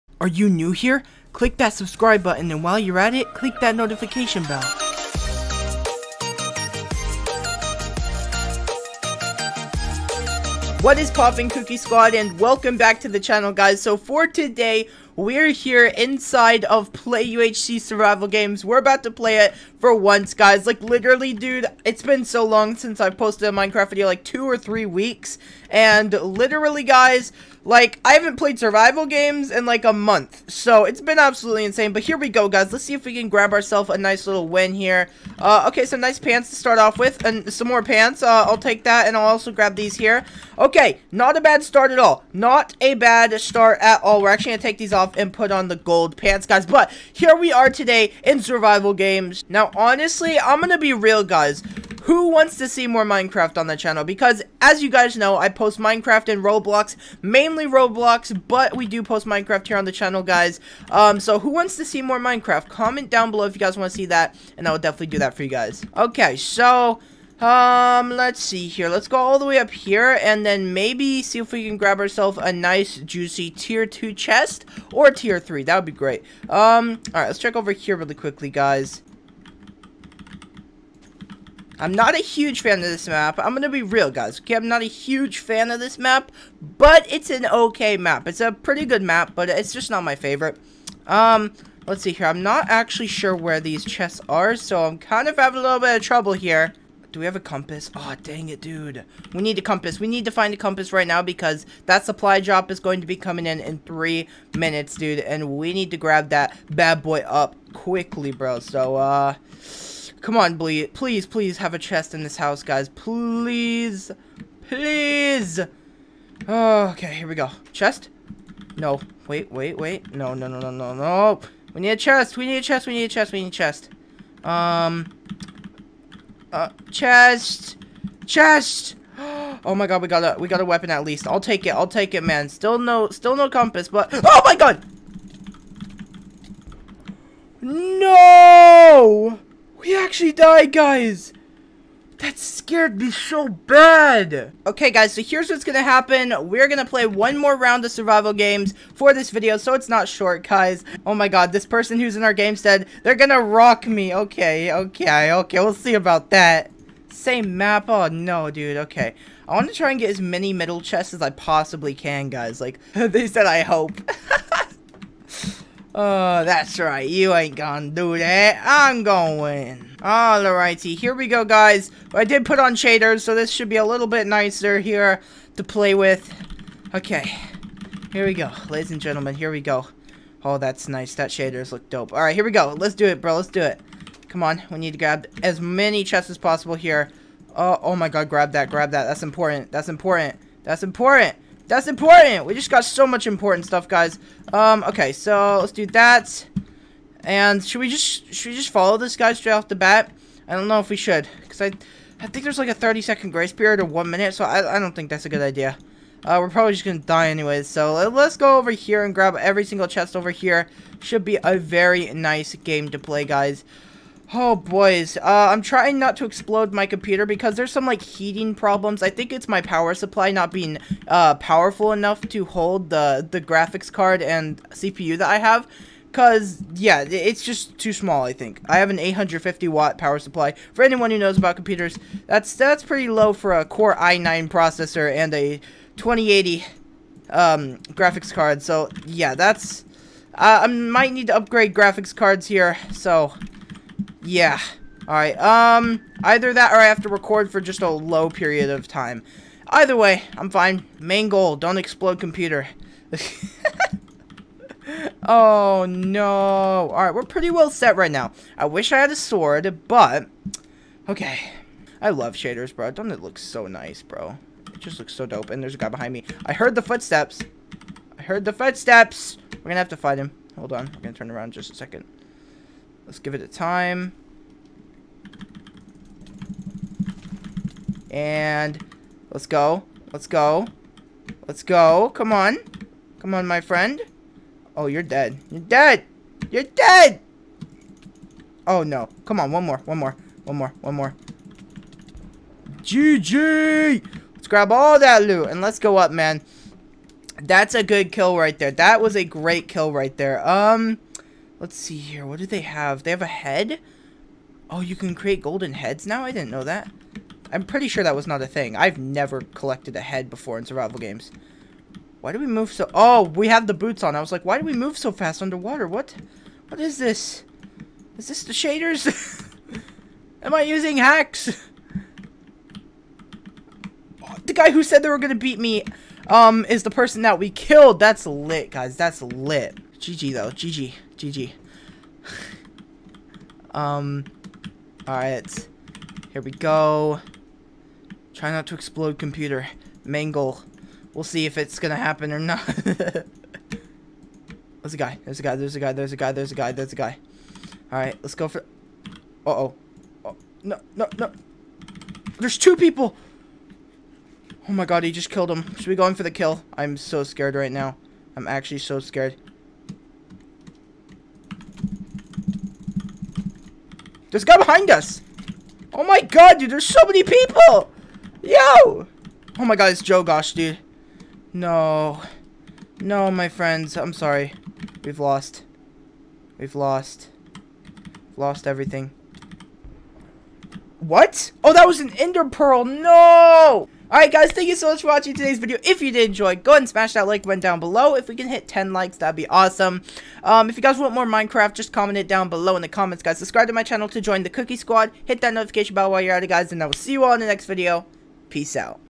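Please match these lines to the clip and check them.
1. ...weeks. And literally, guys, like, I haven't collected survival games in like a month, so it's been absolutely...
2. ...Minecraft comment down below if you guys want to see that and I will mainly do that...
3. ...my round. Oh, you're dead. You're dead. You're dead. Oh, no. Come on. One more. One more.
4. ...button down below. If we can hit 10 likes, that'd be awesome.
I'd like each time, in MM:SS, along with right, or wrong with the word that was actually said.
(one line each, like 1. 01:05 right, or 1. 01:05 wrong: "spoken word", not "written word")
1. 00:24 wrong: "played", not "collected"
2. 01:02 wrong: "definitely", not "mainly"
3. 04:43 wrong: "friend", not "round"
4. 06:27 right.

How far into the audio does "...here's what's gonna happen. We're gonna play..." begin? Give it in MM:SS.
02:25.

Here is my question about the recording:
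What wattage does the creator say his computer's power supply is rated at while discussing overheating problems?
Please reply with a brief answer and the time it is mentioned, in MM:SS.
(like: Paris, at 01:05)
850 watts, at 03:48.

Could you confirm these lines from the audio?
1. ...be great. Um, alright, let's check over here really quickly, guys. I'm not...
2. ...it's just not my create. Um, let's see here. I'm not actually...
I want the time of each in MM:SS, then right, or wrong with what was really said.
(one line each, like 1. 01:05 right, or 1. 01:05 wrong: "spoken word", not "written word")
1. 01:15 right
2. 01:29 wrong: "favorite", not "create".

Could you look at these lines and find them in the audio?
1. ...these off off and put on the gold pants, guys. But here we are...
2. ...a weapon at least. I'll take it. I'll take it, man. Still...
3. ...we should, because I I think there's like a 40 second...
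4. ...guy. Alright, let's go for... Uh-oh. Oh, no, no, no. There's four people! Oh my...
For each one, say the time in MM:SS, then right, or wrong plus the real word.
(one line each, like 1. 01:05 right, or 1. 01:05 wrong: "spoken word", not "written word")
1. 00:44 right
2. 02:10 right
3. 03:20 wrong: "30", not "40"
4. 05:46 wrong: "two", not "four".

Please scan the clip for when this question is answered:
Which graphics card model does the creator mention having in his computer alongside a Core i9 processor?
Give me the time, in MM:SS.
03:55.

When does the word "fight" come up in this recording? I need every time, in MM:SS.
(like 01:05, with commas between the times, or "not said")
04:29.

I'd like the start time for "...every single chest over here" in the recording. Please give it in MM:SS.
03:29.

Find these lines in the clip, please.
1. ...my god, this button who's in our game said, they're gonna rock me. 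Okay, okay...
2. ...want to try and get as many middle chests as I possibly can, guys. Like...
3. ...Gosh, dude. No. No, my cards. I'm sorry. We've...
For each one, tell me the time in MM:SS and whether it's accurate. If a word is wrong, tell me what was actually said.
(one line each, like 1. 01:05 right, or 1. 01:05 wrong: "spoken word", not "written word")
1. 02:31 wrong: "person", not "button"
2. 02:39 right
3. 06:10 wrong: "friends", not "cards".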